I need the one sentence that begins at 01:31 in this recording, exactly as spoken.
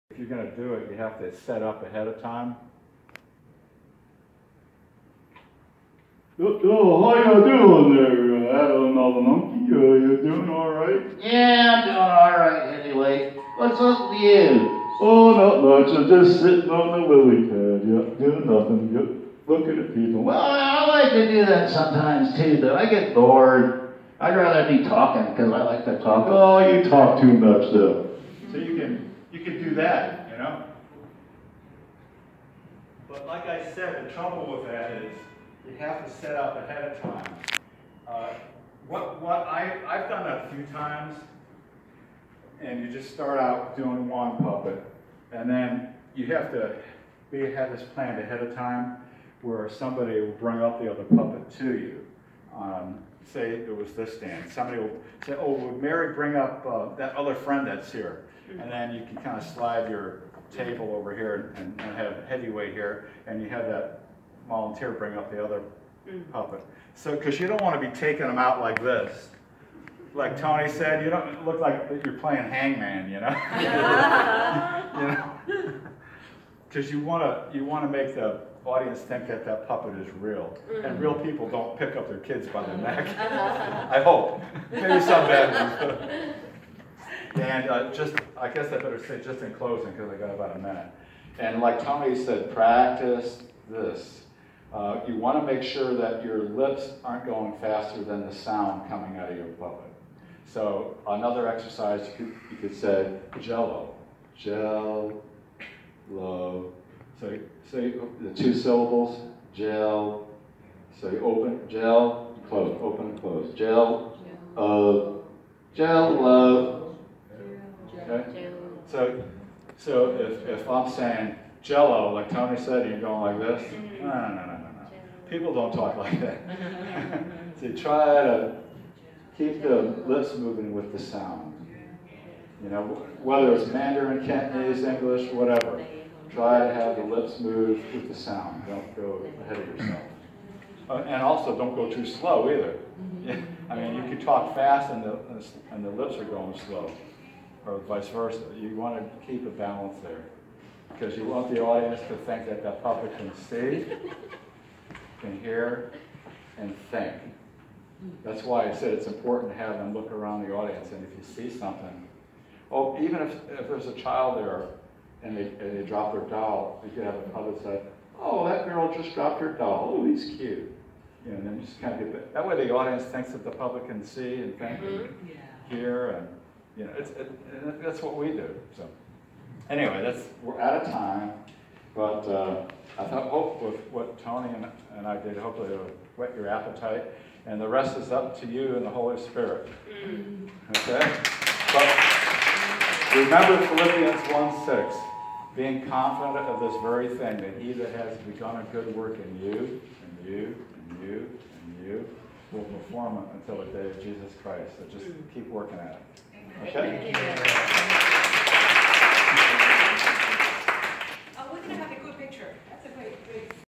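And like Tony said, practice this.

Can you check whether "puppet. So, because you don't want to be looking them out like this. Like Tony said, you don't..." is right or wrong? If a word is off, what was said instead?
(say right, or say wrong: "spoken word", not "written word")
wrong: "taking", not "looking".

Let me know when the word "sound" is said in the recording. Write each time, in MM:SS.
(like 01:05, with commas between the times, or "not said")
01:38, 02:10, 02:18.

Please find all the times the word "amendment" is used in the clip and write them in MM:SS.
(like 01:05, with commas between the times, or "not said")
not said.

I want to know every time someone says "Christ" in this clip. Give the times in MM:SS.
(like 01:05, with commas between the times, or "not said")
03:24.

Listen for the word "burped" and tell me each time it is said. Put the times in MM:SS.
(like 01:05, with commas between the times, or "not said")
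not said.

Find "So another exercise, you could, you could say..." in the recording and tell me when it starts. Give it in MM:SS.
01:40.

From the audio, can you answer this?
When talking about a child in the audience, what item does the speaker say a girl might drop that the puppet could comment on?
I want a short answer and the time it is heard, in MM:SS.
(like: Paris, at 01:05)
her doll, at 02:49.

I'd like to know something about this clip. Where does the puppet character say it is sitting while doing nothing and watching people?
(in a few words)
lily pad.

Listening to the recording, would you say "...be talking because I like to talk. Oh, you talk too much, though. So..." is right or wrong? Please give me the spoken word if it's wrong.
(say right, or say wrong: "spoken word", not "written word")
right.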